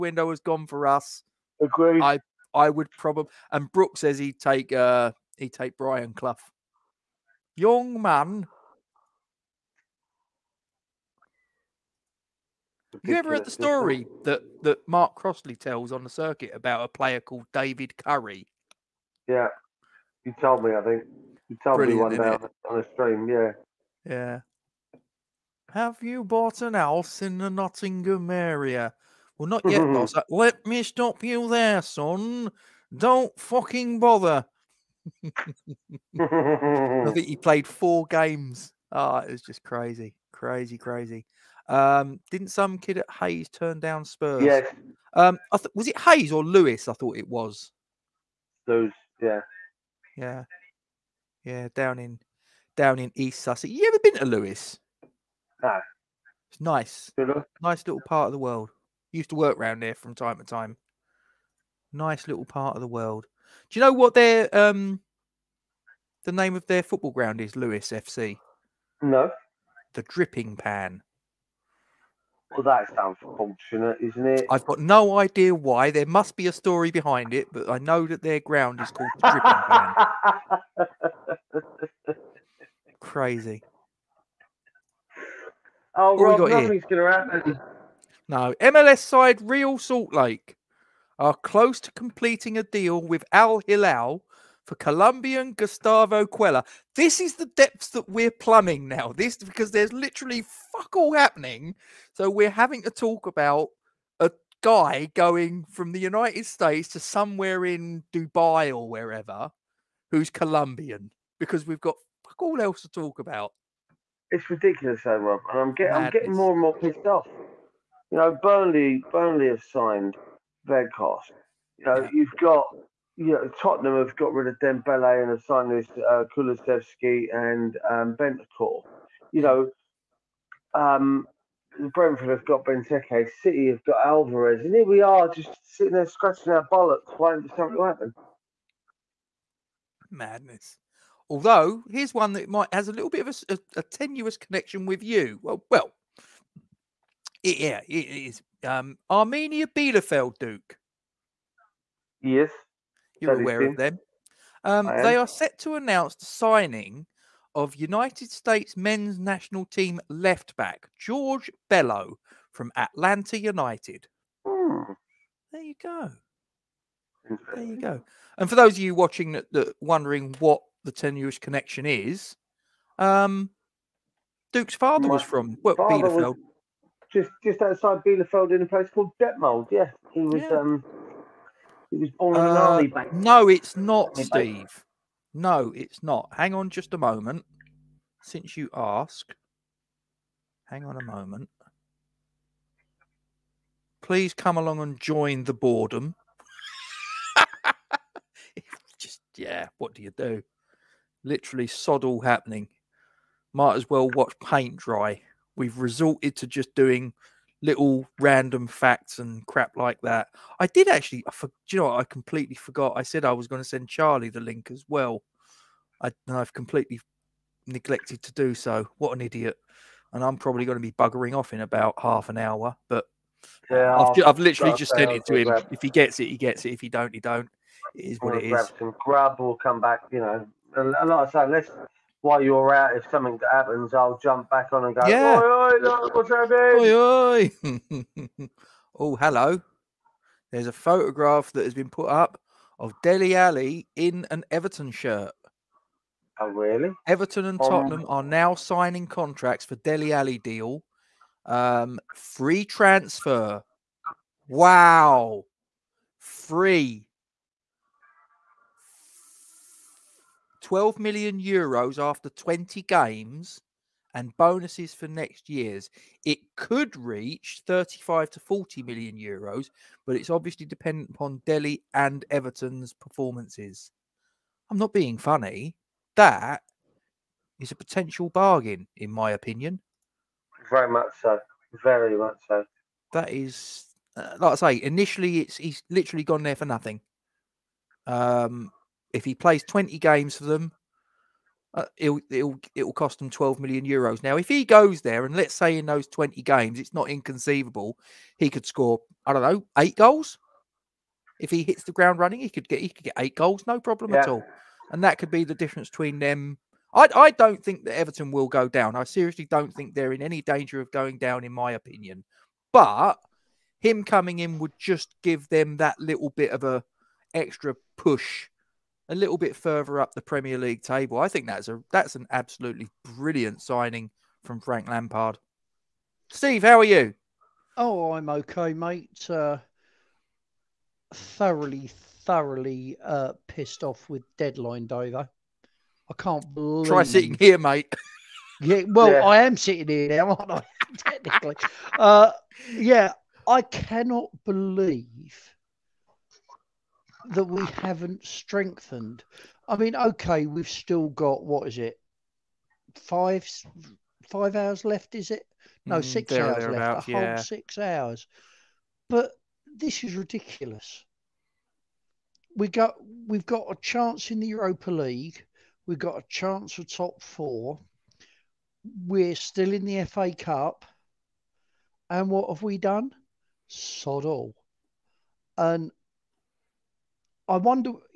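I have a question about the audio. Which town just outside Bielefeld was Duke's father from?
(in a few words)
Detmold.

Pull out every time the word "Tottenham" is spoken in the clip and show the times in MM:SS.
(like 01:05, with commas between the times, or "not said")
02:03, 04:07.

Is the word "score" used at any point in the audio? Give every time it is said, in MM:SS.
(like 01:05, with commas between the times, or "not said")
04:58.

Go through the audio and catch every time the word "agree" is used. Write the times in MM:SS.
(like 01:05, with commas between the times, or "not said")
00:01.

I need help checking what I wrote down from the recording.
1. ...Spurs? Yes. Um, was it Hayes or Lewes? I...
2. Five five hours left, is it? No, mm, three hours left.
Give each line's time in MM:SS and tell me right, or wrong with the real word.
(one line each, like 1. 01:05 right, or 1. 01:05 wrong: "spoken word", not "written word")
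1. 00:44 right
2. 05:52 wrong: "six", not "three".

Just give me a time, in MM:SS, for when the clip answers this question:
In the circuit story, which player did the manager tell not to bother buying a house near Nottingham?
00:17.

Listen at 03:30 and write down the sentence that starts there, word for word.
I did actually, I for, you know, what?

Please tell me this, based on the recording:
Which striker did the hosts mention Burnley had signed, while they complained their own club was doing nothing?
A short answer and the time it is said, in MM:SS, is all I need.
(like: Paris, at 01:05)
Weghorst, at 02:00.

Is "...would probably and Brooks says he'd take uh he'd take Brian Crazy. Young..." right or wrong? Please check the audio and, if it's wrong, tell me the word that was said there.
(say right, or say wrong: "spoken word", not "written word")
wrong: "Clough", not "Crazy".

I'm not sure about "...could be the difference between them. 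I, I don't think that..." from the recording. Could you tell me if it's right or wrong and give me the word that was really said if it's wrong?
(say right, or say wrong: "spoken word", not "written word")
right.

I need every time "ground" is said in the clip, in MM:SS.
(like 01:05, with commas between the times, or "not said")
01:07, 01:18, 05:01.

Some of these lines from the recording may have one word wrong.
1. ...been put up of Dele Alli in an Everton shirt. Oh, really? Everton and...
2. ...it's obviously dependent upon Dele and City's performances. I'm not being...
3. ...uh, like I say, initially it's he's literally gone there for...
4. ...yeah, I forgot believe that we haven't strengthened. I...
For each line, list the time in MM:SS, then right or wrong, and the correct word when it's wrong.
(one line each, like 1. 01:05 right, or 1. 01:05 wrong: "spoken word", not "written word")
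1. 04:01 right
2. 04:30 wrong: "Everton", not "City"
3. 04:44 right
4. 05:42 wrong: "cannot", not "forgot".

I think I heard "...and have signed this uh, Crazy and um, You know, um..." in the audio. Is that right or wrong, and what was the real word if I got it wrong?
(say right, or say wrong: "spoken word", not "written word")
wrong: "Kulusevski", not "Crazy".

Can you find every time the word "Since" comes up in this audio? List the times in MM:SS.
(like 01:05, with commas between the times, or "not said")
03:08.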